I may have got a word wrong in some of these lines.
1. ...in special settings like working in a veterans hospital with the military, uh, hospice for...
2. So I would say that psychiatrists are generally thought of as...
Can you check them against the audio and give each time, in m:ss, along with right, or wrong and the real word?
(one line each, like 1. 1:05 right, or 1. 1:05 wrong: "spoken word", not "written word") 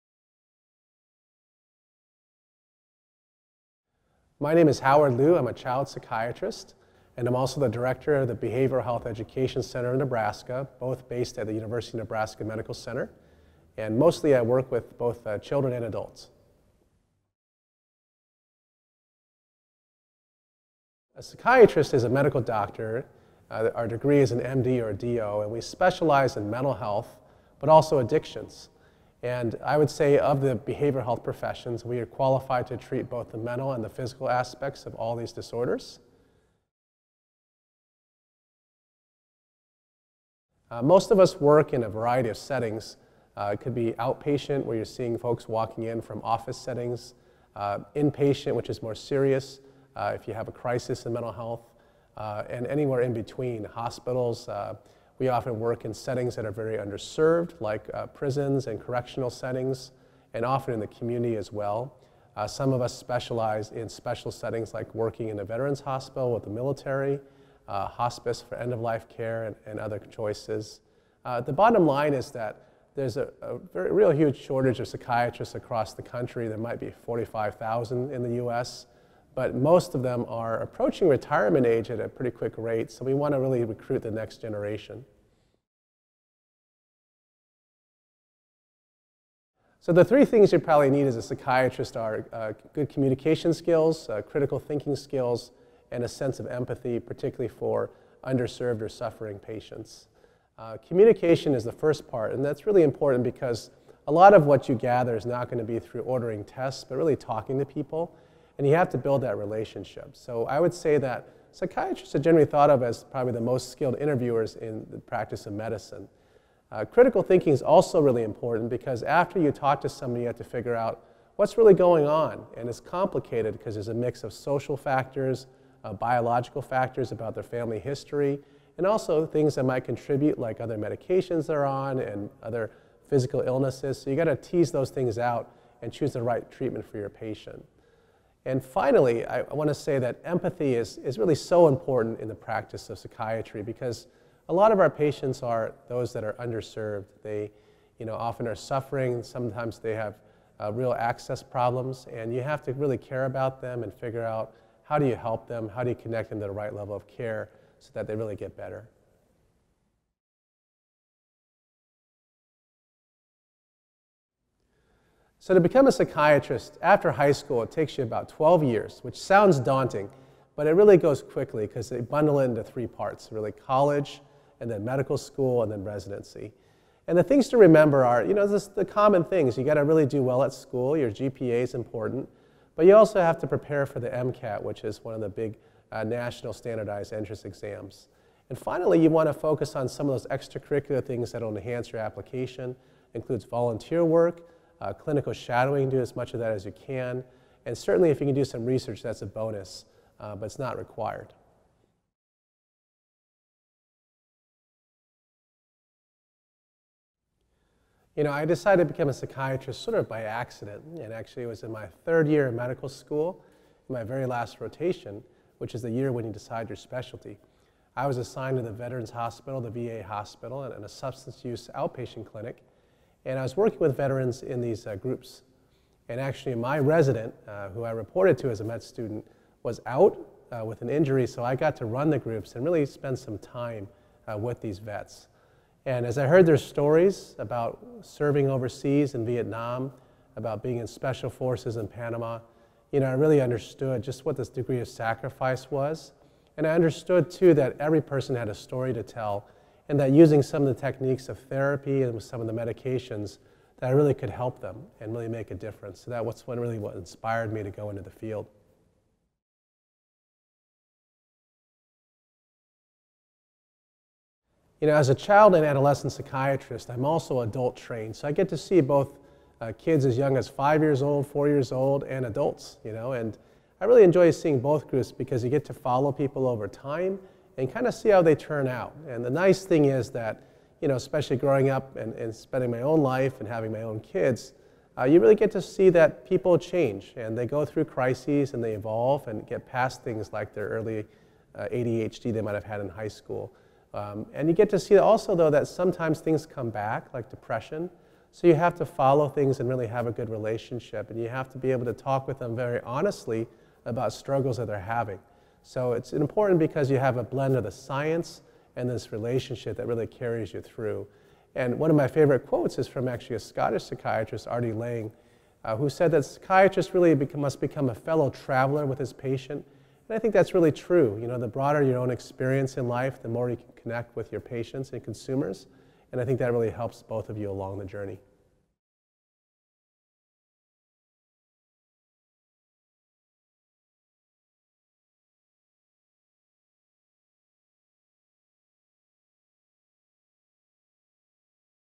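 1. 1:03 right
2. 1:50 right.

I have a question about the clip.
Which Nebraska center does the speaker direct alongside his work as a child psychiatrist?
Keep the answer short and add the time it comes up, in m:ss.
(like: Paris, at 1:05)
Behavioral Health Education Center, at 0:08.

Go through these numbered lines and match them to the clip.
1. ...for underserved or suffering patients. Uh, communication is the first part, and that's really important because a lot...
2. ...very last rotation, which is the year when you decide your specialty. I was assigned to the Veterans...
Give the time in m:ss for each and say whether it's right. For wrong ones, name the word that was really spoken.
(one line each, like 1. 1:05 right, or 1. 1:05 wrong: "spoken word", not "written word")
1. 1:37 right
2. 3:34 right.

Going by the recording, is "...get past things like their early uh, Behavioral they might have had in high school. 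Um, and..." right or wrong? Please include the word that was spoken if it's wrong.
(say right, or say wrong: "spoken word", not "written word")
wrong: "ADHD", not "Behavioral".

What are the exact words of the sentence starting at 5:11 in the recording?
And one of my favorite quotes is from actually a Scottish psychiatrist, R.D.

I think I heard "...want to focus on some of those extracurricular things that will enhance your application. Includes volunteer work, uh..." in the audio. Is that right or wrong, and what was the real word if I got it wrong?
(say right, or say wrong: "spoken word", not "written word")
right.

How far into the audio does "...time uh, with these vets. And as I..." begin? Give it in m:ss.
3:53.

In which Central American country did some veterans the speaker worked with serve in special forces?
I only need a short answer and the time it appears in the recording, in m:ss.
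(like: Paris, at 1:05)
Panama, at 4:01.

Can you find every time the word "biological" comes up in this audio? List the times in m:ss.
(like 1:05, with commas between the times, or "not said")
2:05.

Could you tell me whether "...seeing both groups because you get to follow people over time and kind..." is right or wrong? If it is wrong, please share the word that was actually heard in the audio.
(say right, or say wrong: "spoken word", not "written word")
right.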